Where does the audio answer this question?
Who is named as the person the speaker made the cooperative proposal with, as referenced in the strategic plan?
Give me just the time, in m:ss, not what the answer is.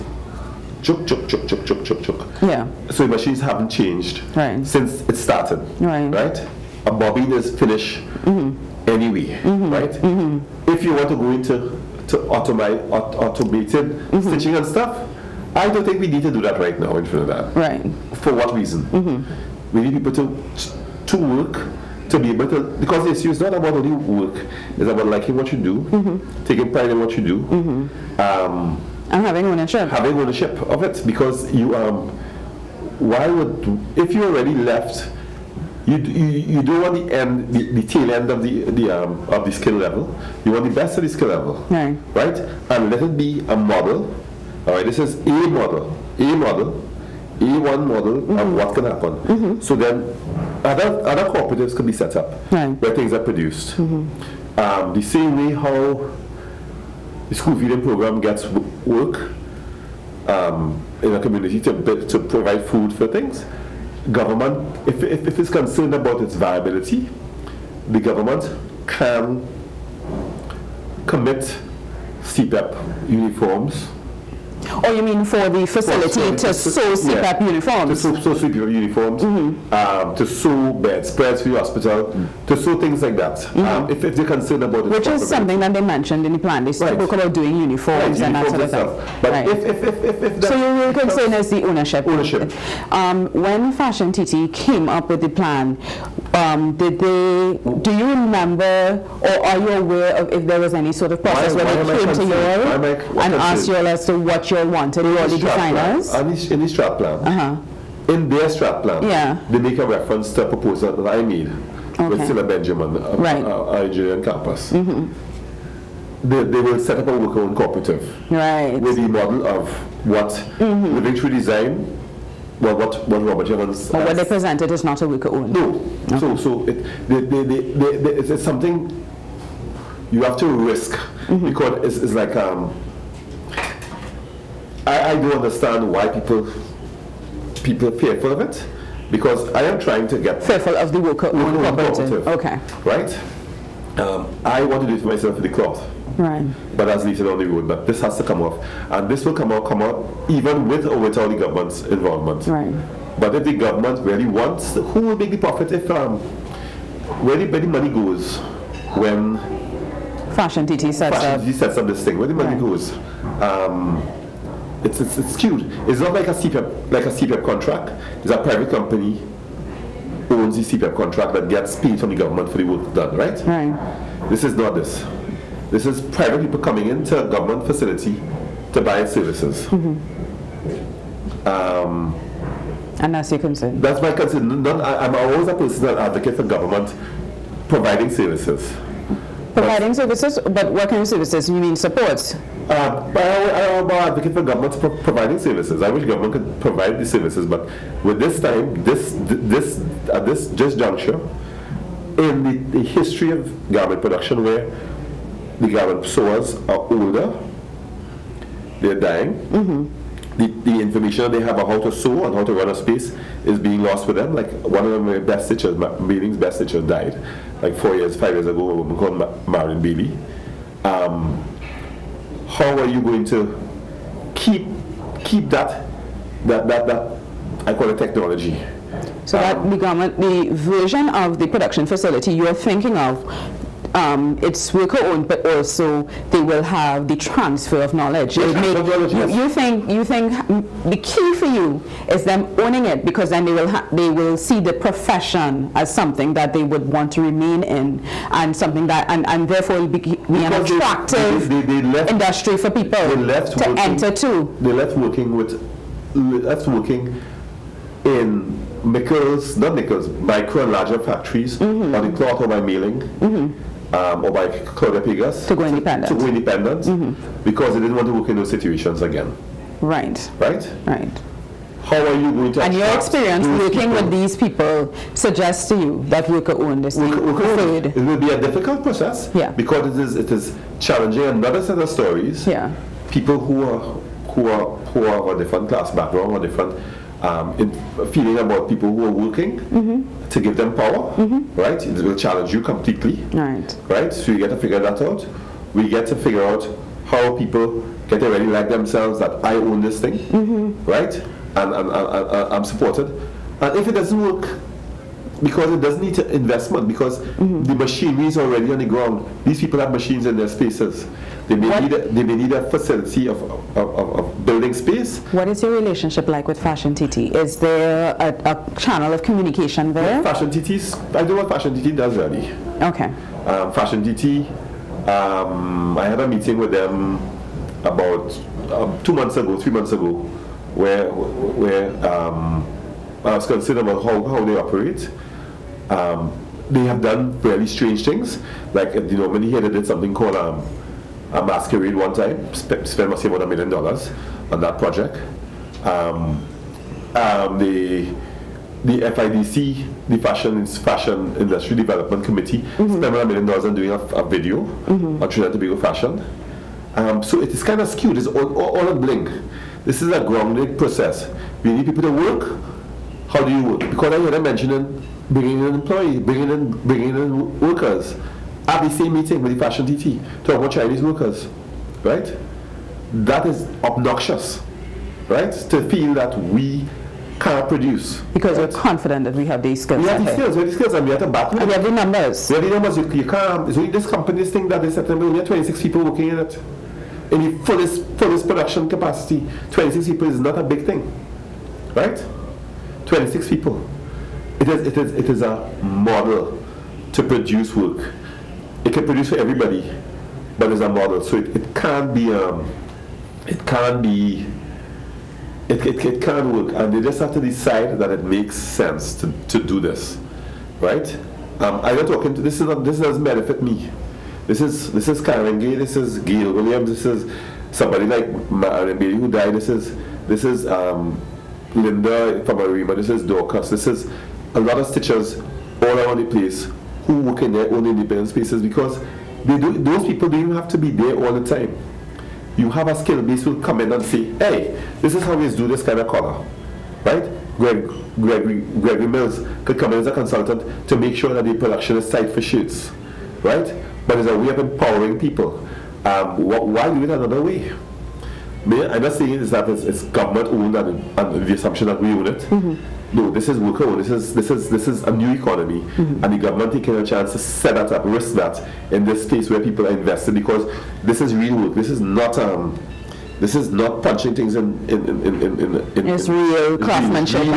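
1:52.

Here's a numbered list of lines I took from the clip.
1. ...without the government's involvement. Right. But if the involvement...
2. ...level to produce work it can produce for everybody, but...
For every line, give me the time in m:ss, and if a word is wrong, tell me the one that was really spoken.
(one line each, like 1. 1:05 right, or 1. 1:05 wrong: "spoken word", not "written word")
1. 2:30 wrong: "government", not "involvement"
2. 6:35 wrong: "model", not "level".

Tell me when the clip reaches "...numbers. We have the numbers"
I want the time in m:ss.
6:21.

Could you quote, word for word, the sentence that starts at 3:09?
Providing but, services, but what kind of services?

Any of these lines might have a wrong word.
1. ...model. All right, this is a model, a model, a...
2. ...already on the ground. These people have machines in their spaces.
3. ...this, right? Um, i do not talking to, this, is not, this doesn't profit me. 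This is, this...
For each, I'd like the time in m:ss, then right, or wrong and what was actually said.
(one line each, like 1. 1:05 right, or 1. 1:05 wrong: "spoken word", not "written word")
1. 0:43 right
2. 5:08 right
3. 6:49 wrong: "benefit", not "profit".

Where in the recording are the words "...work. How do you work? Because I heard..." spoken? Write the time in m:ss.
6:02.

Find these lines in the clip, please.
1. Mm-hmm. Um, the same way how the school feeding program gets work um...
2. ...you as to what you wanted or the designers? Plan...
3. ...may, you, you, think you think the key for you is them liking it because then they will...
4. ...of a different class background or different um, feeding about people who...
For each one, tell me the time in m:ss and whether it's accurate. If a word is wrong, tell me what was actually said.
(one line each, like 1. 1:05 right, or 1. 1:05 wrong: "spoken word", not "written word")
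1. 0:53 right
2. 1:43 right
3. 3:58 wrong: "owning", not "liking"
4. 4:45 right.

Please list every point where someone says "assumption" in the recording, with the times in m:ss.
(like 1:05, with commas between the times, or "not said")
7:31.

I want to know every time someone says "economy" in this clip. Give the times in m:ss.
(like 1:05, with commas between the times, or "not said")
7:35.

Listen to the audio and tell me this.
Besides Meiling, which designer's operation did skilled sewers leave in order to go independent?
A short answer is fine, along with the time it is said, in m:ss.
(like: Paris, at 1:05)
Claudia Pegus, at 4:24.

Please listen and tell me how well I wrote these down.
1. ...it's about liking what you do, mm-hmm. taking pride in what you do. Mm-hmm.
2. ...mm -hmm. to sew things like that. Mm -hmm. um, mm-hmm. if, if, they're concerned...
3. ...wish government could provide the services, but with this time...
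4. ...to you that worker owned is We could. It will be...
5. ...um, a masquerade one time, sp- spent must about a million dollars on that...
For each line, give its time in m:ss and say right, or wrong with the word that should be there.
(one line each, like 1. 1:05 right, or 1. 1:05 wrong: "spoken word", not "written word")
1. 0:24 right
2. 1:21 right
3. 3:15 right
4. 4:35 right
5. 5:40 right.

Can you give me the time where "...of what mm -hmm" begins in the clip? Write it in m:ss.
1:59.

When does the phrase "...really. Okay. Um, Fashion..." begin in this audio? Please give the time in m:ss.
5:22.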